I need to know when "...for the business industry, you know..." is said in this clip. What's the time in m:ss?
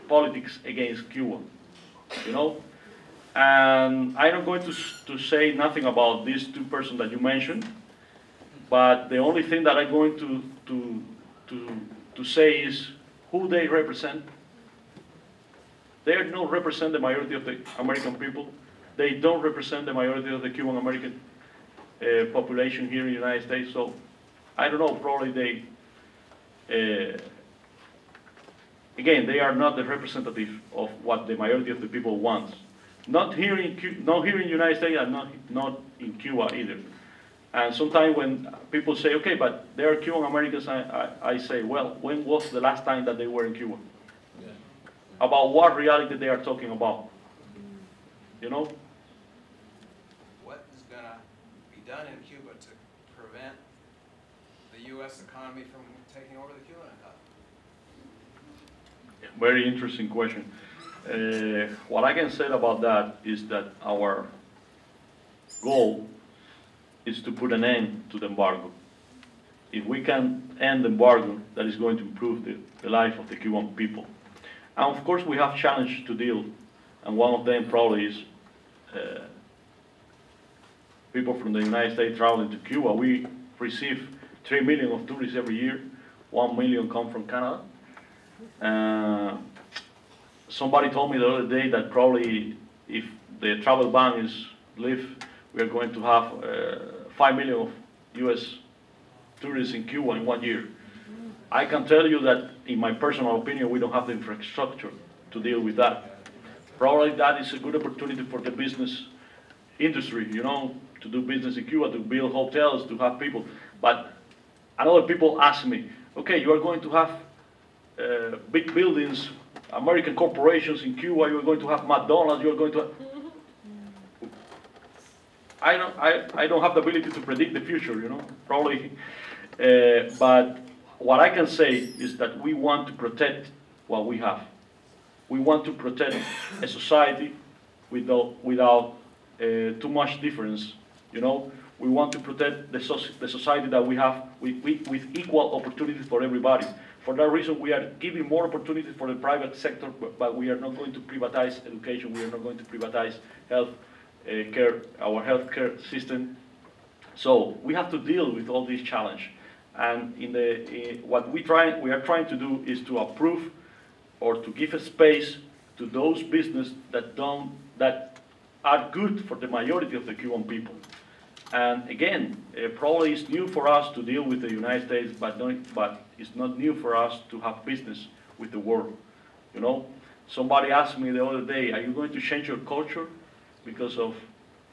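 1:48.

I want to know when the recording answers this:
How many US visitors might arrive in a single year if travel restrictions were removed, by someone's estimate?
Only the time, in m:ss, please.
1:37.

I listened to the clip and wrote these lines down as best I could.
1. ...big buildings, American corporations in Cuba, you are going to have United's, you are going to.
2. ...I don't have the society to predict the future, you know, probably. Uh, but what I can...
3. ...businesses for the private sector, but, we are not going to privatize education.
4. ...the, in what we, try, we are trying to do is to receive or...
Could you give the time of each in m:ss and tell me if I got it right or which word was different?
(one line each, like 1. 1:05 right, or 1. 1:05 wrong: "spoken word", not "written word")
1. 1:58 wrong: "McDonald", not "United"
2. 2:06 wrong: "ability", not "society"
3. 2:28 wrong: "opportunities", not "businesses"
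4. 2:40 wrong: "approve", not "receive".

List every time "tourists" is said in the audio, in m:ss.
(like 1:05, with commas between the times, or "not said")
1:25, 1:39.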